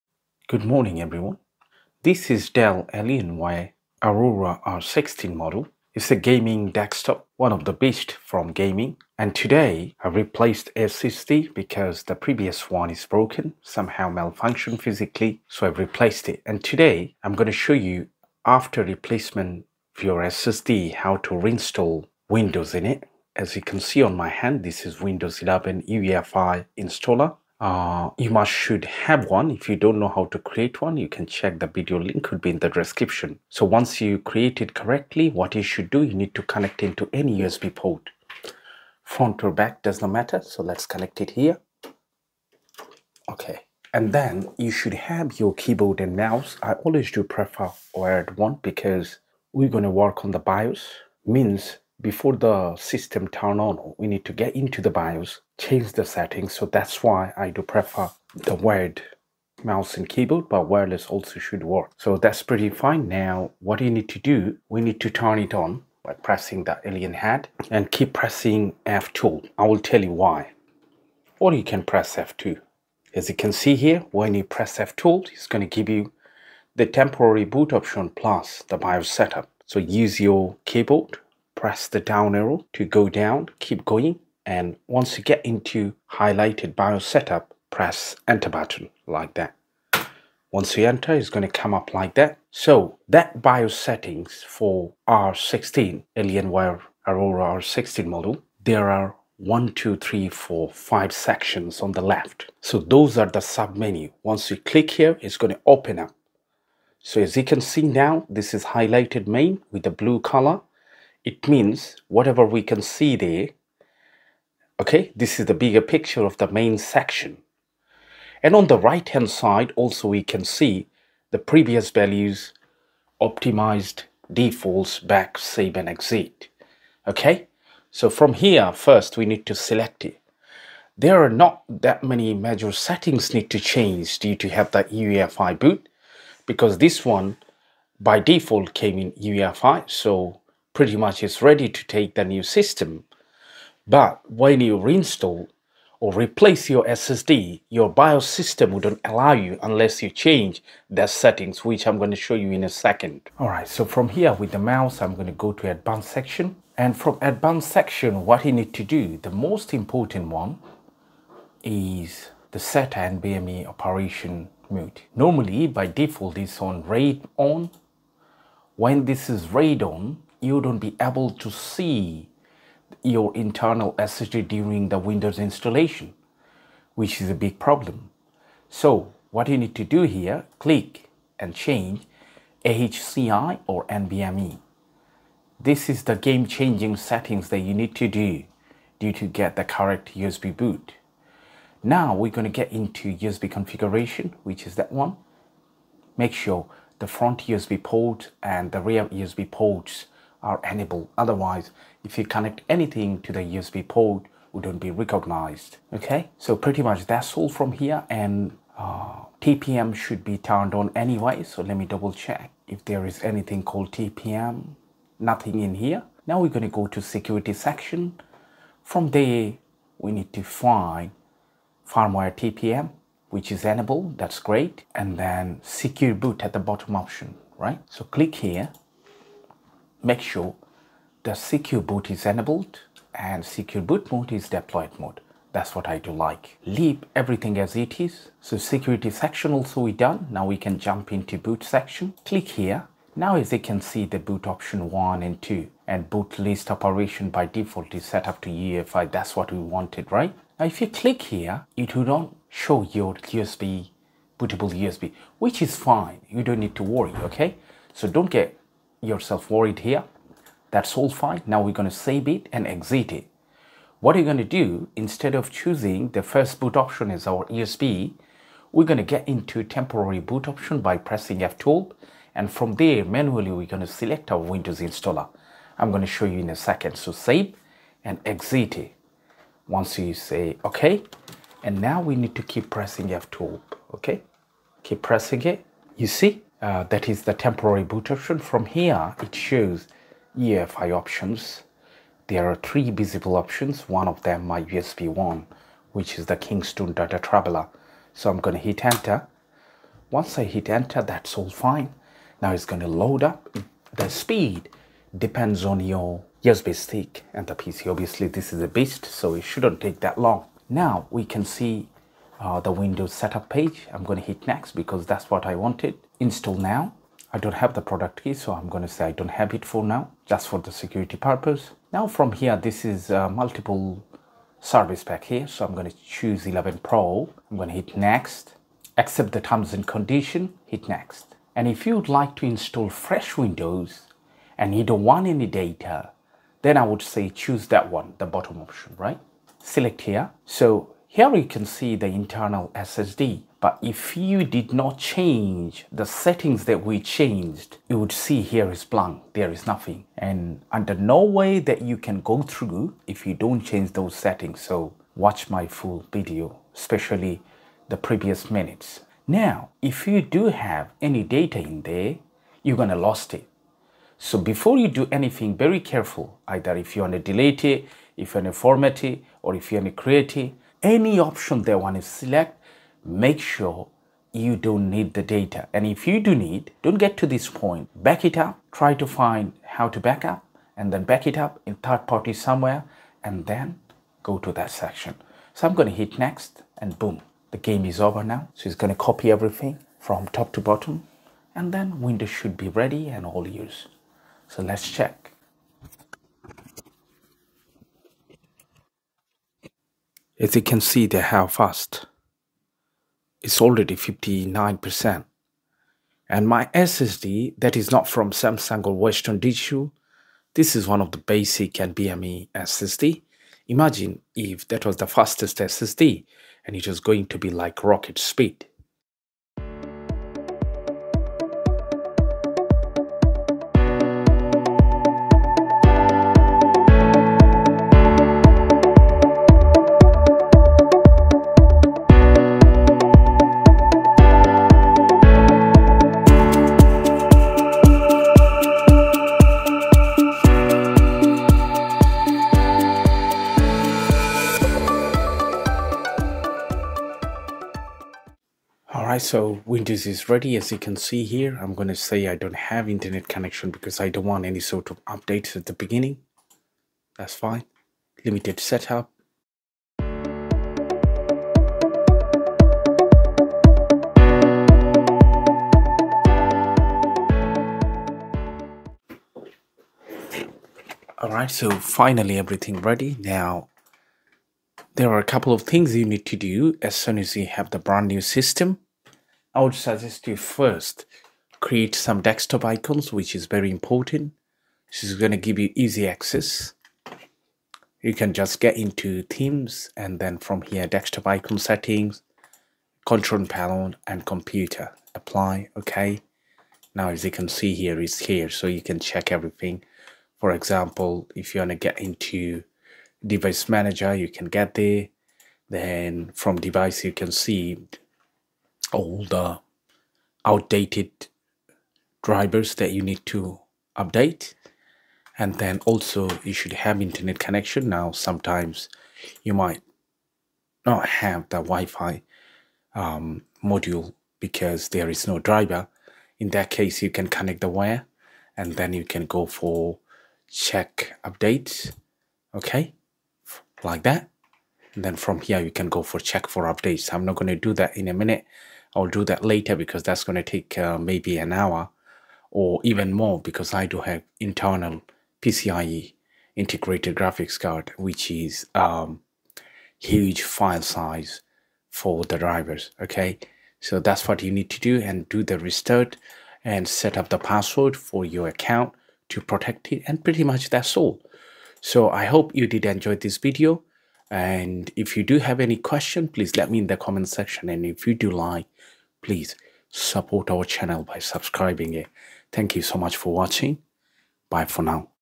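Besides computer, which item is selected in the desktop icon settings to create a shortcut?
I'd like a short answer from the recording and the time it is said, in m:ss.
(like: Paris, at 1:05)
control panel, at 8:13.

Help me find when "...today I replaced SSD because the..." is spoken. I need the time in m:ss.
0:09.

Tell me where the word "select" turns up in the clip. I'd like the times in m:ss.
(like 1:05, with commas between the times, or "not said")
2:09, 4:33, 5:39, 6:12.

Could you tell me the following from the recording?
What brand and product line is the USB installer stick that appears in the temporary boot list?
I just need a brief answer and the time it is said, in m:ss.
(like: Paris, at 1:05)
Kingston Data Traveler, at 4:56.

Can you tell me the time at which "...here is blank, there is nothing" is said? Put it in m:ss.
5:48.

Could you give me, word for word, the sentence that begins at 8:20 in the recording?
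For example, if you want to get into device manager, you can get there.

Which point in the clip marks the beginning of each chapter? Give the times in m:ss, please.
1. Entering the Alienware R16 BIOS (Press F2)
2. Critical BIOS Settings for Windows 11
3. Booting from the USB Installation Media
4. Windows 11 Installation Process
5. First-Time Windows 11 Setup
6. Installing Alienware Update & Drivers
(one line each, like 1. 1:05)
1. 0:45
2. 1:30
3. 3:15
4. 4:00
5. 7:45
6. 9:30.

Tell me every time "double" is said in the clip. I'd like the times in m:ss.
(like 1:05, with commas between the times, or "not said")
3:31.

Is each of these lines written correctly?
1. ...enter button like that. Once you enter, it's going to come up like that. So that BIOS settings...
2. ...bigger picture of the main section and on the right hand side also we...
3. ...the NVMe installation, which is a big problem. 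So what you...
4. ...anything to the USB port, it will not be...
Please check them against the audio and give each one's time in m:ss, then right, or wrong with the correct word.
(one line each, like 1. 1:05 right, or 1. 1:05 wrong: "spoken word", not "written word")
1. 1:28 right
2. 1:55 right
3. 2:54 wrong: "Windows", not "NVMe"
4. 3:22 right.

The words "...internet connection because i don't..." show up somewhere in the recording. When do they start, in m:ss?
7:32.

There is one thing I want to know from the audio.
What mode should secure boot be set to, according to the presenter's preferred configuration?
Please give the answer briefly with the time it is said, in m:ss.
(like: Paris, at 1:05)
deployed mode, at 3:54.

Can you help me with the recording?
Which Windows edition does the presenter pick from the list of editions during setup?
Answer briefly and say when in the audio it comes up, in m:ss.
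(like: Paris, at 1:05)
11 Pro, at 5:26.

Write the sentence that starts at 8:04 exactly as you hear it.
This is going to give you easy access.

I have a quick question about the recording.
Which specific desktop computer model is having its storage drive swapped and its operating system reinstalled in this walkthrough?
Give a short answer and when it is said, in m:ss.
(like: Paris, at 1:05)
Alienware Aurora R16, at 0:02.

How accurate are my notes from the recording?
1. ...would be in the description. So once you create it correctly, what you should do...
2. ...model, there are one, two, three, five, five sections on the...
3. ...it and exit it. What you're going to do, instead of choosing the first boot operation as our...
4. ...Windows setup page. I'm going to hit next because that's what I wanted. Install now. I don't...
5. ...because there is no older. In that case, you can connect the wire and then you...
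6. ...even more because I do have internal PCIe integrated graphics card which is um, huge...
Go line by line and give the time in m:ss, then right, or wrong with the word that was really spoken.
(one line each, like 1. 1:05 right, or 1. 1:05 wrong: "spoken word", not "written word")
1. 0:32 right
2. 1:38 wrong: "four", not "five"
3. 4:22 wrong: "option", not "operation"
4. 5:12 right
5. 8:44 wrong: "driver", not "older"
6. 9:02 right.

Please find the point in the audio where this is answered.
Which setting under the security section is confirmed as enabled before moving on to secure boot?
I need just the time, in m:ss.
3:41.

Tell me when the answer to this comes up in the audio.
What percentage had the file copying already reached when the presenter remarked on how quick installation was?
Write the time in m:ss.
6:43.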